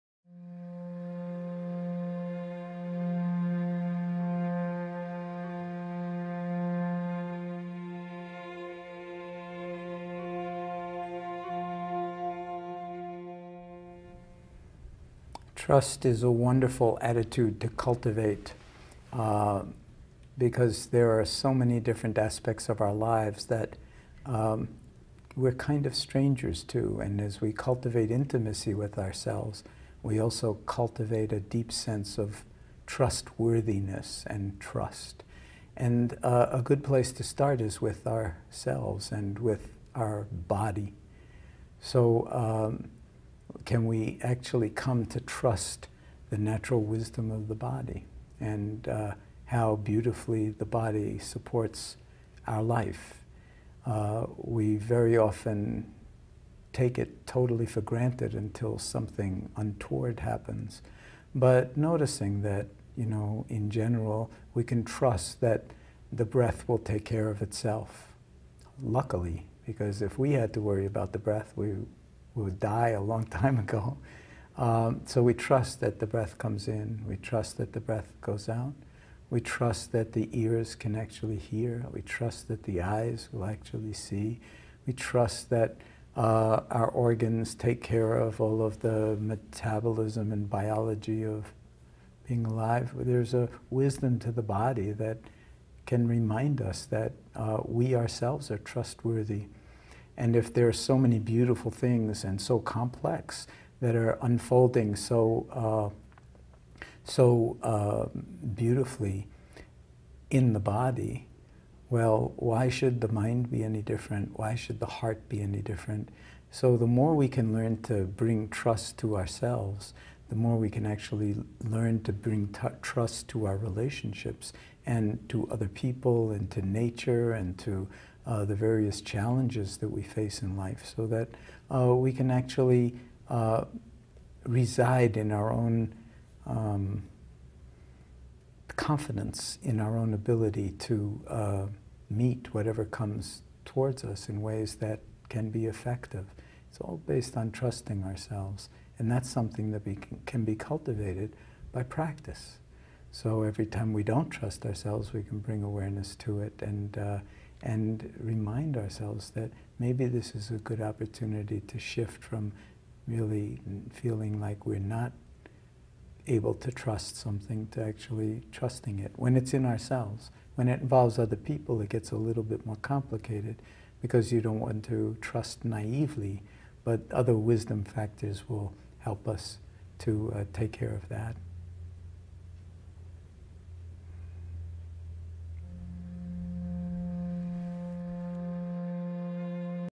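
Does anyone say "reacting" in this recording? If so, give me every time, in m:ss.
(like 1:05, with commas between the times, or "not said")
not said.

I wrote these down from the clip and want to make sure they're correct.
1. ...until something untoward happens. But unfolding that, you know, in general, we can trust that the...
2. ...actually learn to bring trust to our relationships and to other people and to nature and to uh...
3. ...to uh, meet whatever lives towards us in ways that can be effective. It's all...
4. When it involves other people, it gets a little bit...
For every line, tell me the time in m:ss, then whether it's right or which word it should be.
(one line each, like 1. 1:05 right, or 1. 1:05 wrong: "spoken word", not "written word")
1. 0:58 wrong: "noticing", not "unfolding"
2. 2:00 right
3. 2:20 wrong: "comes", not "lives"
4. 2:50 right.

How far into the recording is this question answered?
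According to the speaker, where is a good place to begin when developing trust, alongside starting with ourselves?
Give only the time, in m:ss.
0:39.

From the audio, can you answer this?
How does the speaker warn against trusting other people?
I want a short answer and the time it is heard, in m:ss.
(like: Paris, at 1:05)
naively, at 2:55.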